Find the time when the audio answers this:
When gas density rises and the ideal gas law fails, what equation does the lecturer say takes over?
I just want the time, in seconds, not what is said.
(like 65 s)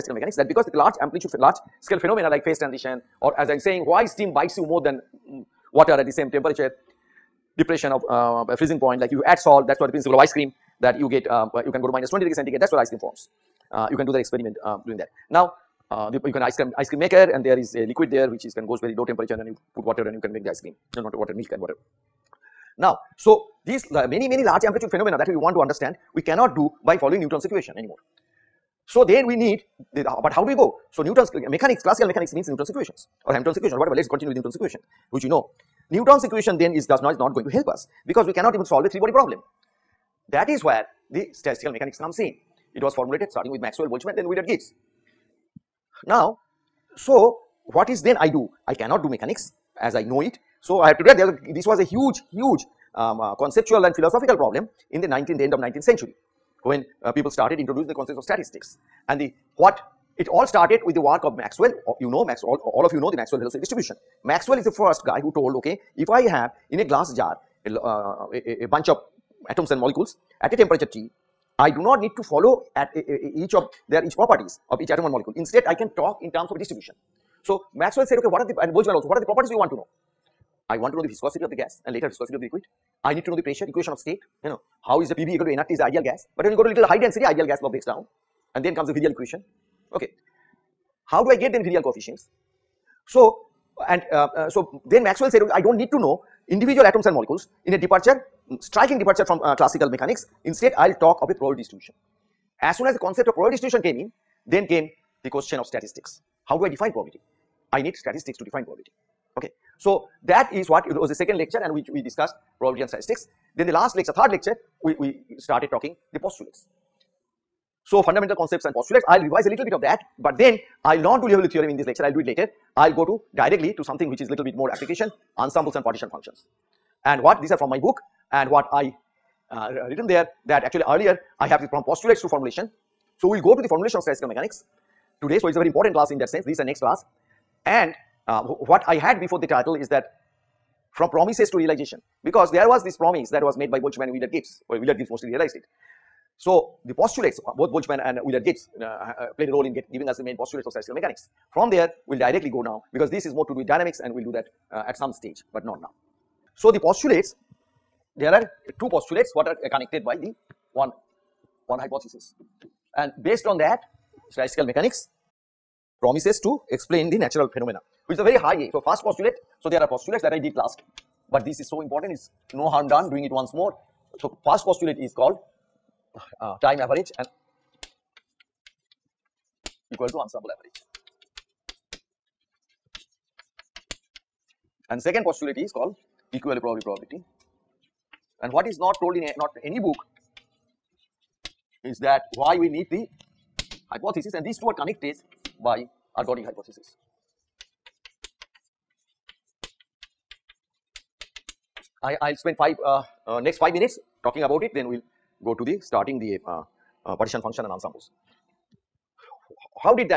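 88 s.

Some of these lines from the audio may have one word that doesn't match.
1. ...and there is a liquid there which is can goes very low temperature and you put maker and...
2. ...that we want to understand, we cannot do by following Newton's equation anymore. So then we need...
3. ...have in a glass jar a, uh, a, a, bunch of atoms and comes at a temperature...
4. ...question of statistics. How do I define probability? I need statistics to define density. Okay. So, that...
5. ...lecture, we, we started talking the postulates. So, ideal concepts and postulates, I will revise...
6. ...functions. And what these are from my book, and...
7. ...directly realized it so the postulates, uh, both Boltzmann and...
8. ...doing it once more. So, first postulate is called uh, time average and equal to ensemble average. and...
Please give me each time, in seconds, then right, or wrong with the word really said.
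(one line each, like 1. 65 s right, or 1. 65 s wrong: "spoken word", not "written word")
1. 17 s wrong: "water", not "maker"
2. 25 s right
3. 66 s wrong: "molecules", not "comes"
4. 105 s wrong: "probability", not "density"
5. 114 s wrong: "fundamental", not "ideal"
6. 126 s right
7. 145 s wrong: "mostly", not "directly"
8. 173 s right.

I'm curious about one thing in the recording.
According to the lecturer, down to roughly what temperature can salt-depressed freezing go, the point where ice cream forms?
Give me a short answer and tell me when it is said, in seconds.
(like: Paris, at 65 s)
-20 degrees centigrade, at 11 s.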